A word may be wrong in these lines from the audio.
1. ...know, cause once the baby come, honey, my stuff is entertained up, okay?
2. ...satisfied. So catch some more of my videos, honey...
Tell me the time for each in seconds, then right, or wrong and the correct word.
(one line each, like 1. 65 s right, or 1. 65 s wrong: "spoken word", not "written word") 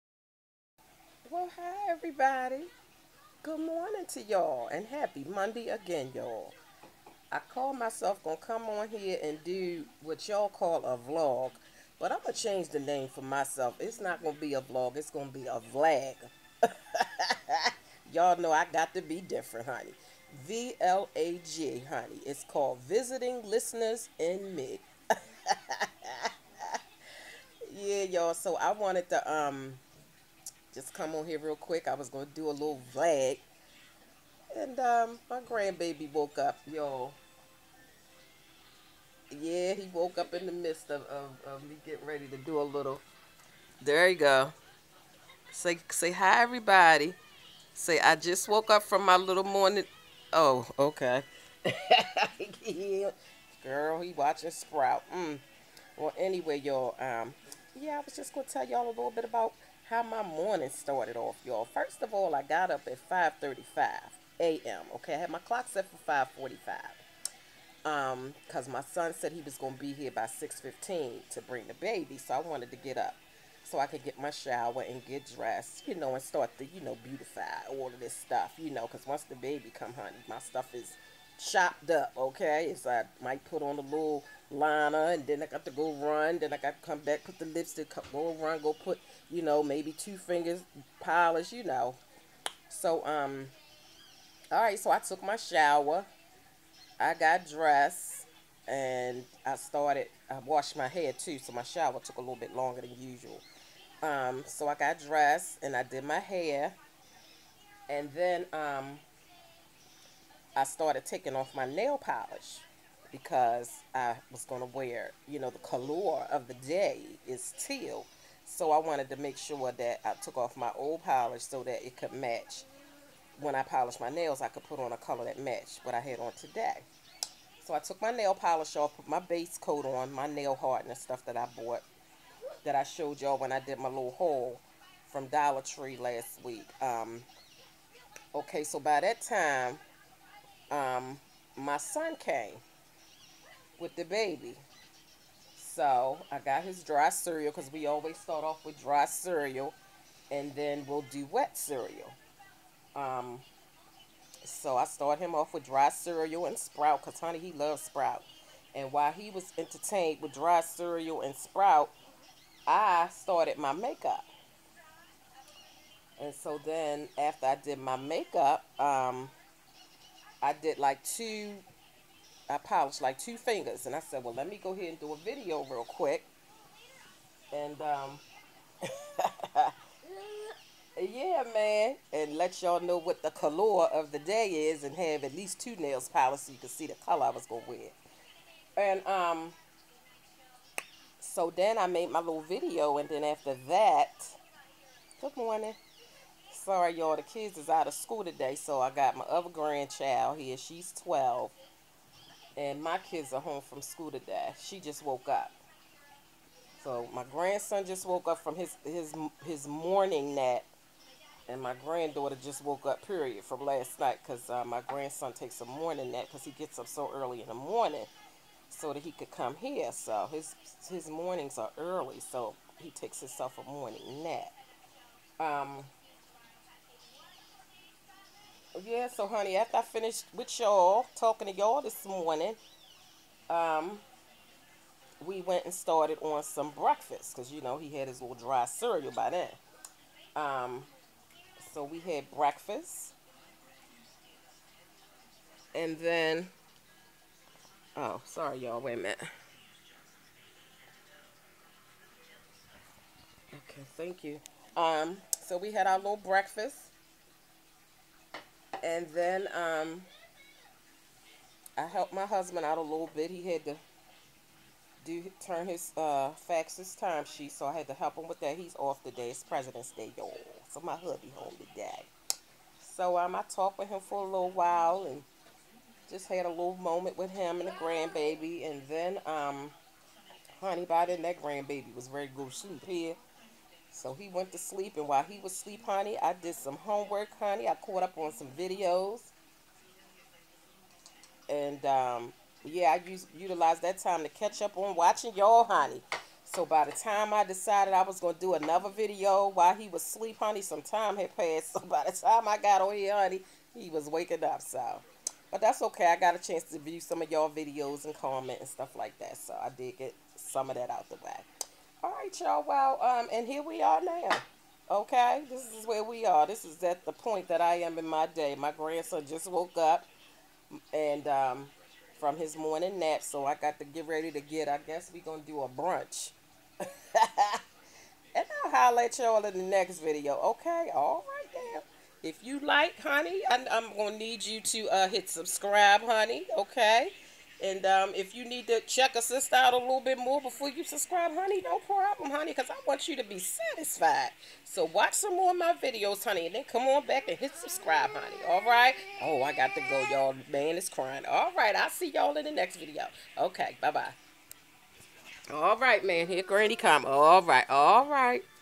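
1. 78 s wrong: "chopped", not "entertained"
2. 343 s wrong: "watch", not "catch".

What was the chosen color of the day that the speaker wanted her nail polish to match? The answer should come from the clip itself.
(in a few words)
Teal.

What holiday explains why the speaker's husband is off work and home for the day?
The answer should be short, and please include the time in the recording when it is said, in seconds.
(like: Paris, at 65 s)
President's Day, at 269 s.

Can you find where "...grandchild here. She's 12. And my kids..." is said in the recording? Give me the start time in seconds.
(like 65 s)
199 s.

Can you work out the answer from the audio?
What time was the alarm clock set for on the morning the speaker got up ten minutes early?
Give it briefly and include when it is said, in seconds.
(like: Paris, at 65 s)
5:45, at 65 s.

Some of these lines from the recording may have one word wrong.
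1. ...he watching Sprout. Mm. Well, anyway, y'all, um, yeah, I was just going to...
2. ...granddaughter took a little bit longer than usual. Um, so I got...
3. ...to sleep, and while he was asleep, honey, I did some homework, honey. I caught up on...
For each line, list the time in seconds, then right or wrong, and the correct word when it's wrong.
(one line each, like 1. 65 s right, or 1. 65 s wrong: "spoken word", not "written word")
1. 54 s right
2. 101 s wrong: "shower", not "granddaughter"
3. 284 s right.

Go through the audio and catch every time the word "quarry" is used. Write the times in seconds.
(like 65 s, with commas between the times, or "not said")
not said.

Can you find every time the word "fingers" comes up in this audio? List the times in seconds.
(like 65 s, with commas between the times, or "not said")
90 s, 173 s.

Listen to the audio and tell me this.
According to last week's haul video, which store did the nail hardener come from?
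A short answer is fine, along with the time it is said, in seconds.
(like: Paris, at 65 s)
Dollar Tree, at 135 s.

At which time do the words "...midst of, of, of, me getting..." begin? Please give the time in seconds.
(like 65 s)
40 s.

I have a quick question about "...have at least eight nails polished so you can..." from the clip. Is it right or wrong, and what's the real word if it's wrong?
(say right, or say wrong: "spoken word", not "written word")
wrong: "two", not "eight".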